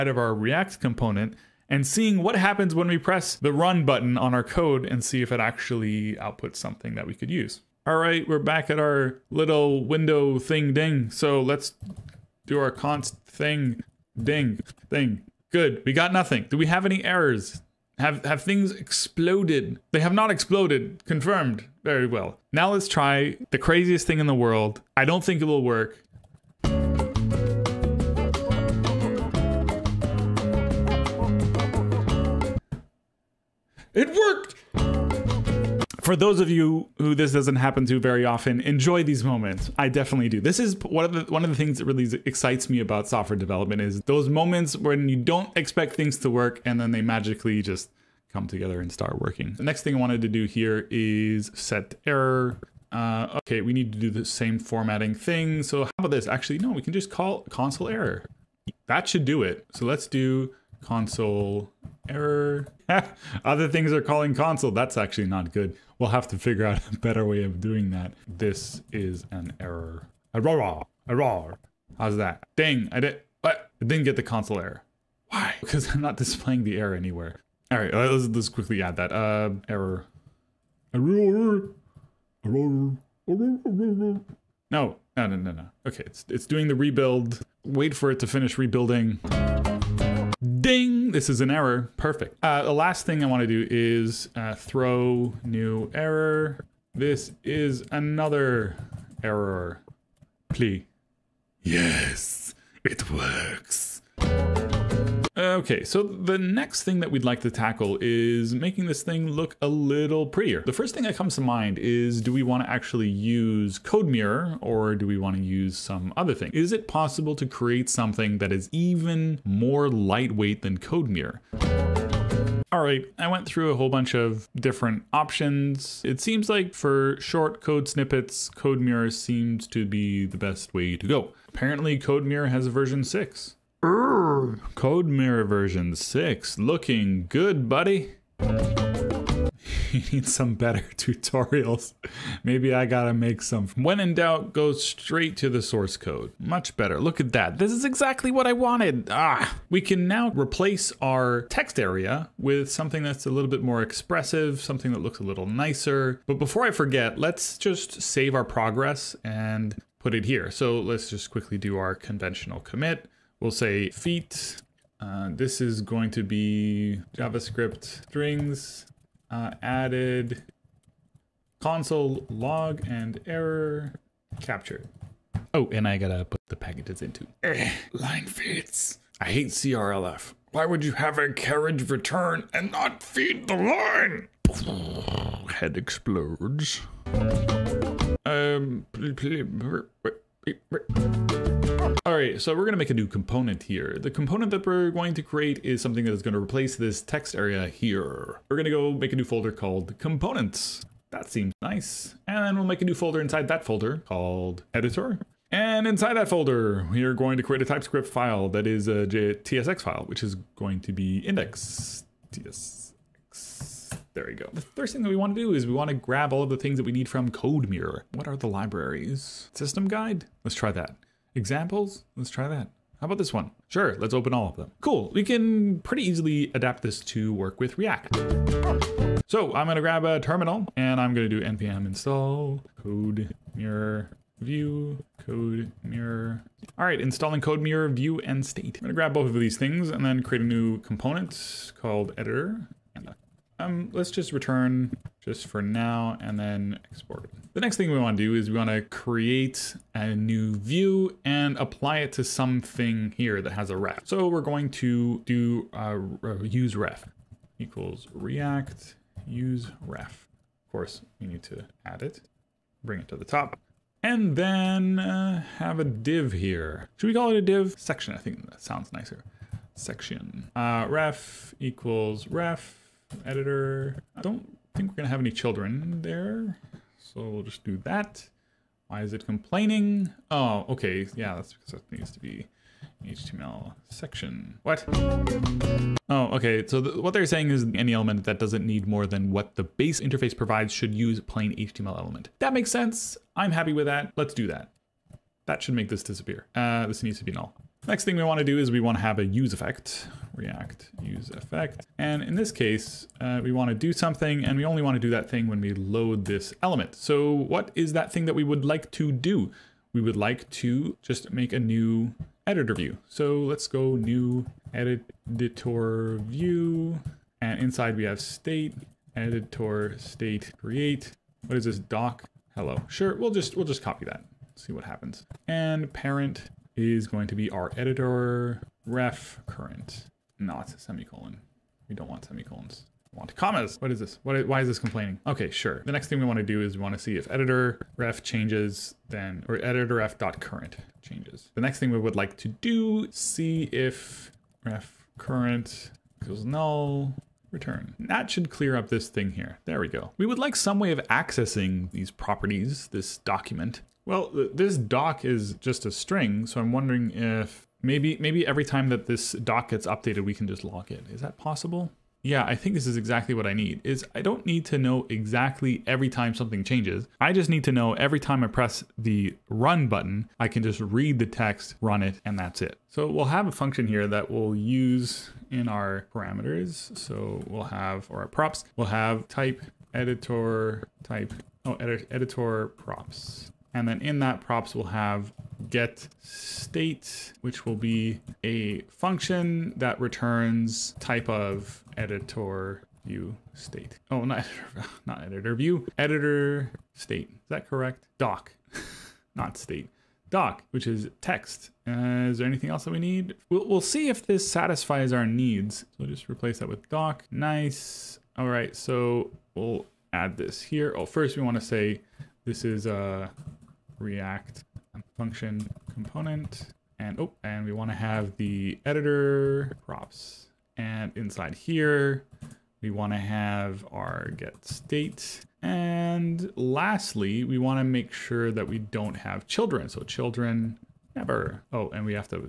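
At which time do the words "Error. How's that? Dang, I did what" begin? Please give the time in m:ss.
1:11.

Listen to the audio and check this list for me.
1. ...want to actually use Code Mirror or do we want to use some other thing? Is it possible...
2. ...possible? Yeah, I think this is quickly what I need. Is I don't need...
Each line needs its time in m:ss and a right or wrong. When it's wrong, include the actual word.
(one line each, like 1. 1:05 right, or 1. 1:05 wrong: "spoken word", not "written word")
1. 1:52 right
2. 6:01 wrong: "exactly", not "quickly".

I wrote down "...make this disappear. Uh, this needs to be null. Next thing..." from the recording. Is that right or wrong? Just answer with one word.
right.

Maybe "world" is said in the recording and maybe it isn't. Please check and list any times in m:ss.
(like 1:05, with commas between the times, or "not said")
0:24.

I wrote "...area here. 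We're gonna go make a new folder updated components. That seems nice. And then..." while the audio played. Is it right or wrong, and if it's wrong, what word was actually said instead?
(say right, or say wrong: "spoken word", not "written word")
wrong: "called", not "updated".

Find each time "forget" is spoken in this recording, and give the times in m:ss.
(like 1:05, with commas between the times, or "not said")
2:36.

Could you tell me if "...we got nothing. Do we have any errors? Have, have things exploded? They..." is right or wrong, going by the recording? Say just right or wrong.
right.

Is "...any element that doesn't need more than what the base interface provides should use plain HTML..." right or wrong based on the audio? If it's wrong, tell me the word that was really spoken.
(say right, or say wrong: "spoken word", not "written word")
right.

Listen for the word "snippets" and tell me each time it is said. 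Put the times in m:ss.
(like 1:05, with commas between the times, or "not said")
2:07.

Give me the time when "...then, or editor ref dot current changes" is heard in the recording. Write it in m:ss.
5:39.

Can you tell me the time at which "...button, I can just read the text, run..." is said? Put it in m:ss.
6:09.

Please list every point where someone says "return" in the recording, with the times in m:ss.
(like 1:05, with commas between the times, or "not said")
3:01, 4:04, 5:47, 6:29.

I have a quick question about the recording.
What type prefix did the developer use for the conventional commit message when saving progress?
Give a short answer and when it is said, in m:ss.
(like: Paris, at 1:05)
feat, at 2:43.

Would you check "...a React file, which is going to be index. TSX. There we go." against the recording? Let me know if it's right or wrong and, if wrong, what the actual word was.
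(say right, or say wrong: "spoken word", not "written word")
wrong: "TSX", not "React".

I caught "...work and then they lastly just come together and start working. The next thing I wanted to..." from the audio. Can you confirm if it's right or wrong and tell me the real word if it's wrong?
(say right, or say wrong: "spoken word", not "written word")
wrong: "magically", not "lastly".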